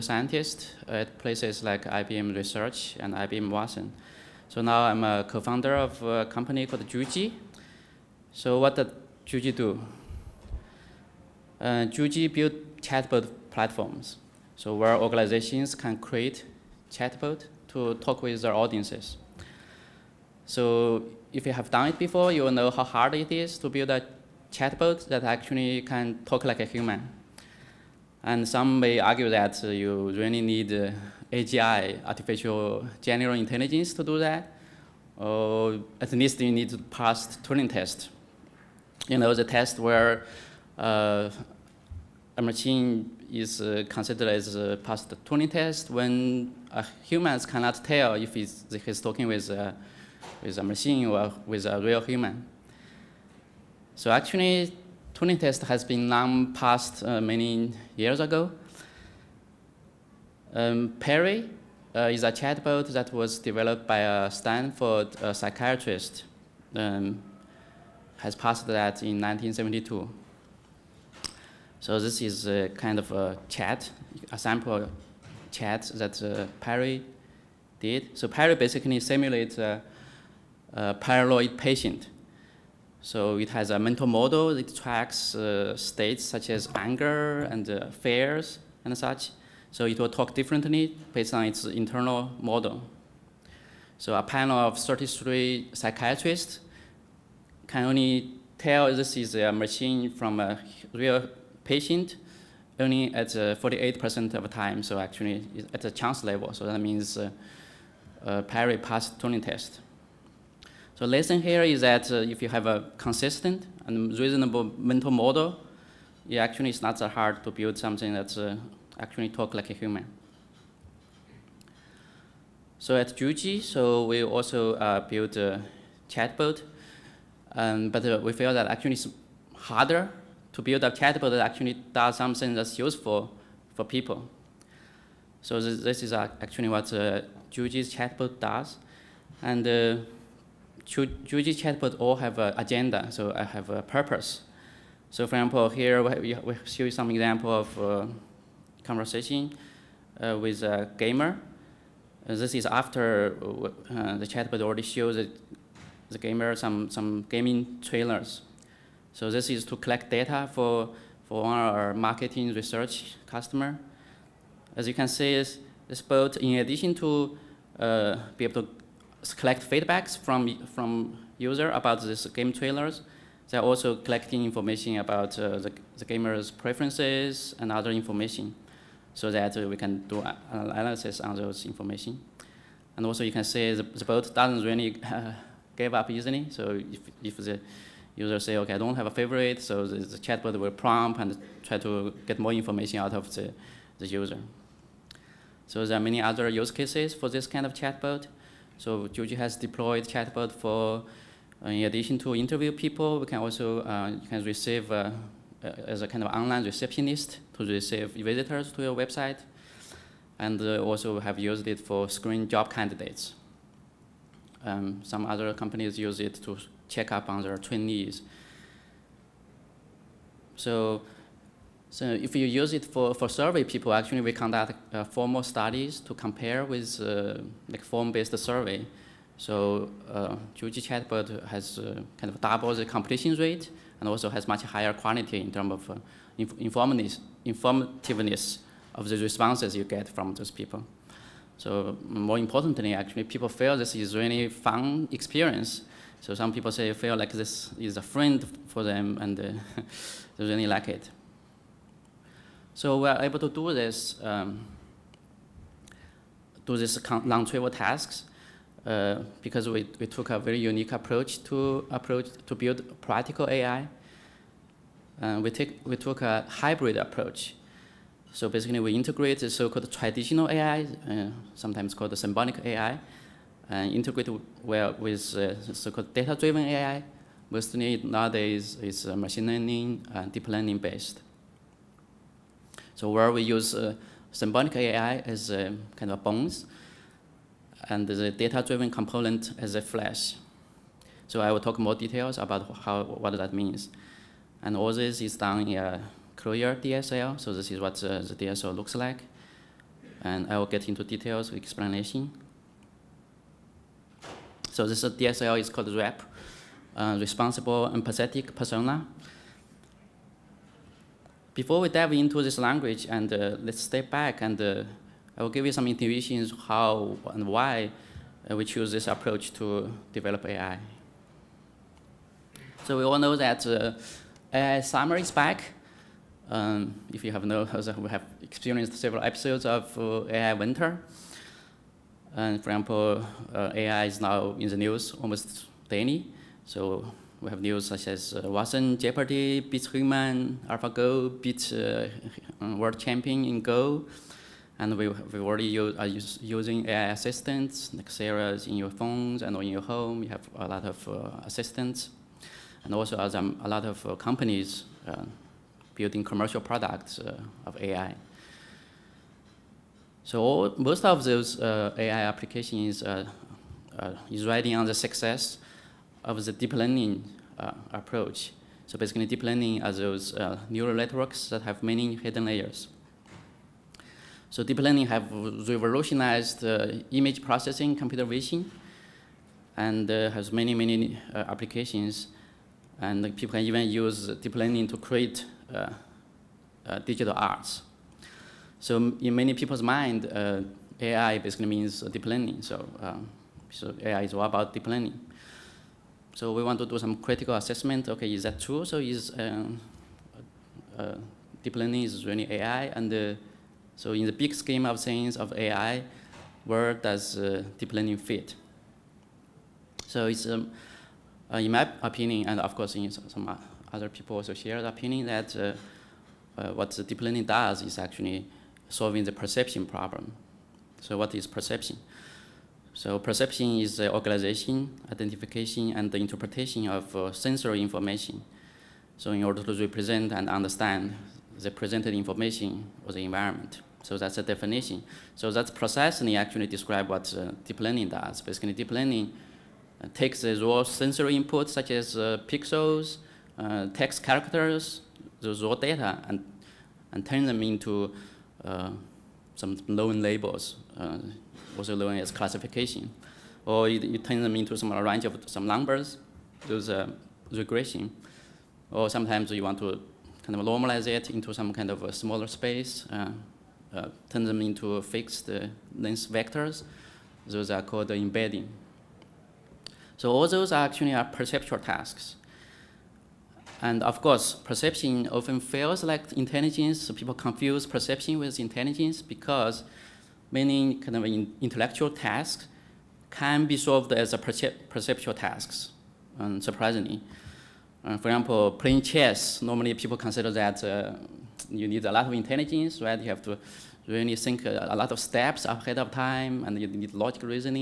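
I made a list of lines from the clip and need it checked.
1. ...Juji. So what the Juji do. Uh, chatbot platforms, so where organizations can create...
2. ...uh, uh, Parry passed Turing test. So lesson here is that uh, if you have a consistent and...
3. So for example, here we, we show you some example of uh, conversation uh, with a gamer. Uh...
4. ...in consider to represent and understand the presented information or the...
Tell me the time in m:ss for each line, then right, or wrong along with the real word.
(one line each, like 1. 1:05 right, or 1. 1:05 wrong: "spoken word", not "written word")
1. 0:06 right
2. 1:47 right
3. 2:25 right
4. 7:09 wrong: "order", not "consider".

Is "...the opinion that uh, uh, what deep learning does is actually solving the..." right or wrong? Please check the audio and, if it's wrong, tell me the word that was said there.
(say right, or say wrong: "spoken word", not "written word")
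right.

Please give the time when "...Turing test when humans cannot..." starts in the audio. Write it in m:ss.
0:45.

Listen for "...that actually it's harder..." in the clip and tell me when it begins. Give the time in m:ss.
2:08.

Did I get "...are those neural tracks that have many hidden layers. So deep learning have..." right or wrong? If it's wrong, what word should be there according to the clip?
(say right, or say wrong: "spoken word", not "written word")
wrong: "networks", not "tracks".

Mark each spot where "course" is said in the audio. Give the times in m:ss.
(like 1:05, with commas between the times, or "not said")
6:52, 7:54.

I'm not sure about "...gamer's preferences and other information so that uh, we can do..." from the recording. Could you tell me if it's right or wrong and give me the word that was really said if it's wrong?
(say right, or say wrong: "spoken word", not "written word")
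right.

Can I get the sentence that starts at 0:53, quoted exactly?
So actually, Turing test has been long passed uh, many years ago.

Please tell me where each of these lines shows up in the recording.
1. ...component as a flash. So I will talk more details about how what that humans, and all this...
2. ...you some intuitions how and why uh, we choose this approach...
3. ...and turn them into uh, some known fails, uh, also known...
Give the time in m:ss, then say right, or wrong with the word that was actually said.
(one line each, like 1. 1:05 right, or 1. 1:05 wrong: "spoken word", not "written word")
1. 4:48 wrong: "means", not "humans"
2. 5:15 right
3. 7:27 wrong: "labels", not "fails".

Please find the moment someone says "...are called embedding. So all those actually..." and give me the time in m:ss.
7:47.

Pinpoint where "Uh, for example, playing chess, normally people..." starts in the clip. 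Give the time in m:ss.
8:08.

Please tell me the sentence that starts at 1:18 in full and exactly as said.
So Parry basically simulates a, a, paranoid patient.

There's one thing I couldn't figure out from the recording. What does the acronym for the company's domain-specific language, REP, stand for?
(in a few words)
Responsible Empathetic Persona.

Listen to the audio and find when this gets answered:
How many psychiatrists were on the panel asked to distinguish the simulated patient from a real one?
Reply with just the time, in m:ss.
1:34.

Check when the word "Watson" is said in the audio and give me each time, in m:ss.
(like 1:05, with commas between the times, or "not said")
0:03, 5:38.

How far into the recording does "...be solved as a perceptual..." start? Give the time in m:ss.
8:03.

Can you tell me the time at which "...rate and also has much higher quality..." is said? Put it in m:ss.
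3:53.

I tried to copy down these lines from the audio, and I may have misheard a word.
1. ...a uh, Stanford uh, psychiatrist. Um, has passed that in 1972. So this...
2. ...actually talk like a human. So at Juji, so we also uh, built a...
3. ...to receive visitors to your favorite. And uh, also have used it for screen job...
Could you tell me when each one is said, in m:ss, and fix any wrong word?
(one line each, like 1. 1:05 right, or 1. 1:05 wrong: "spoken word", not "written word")
1. 1:03 right
2. 1:58 right
3. 3:27 wrong: "website", not "favorite".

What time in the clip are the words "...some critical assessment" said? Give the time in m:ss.
6:36.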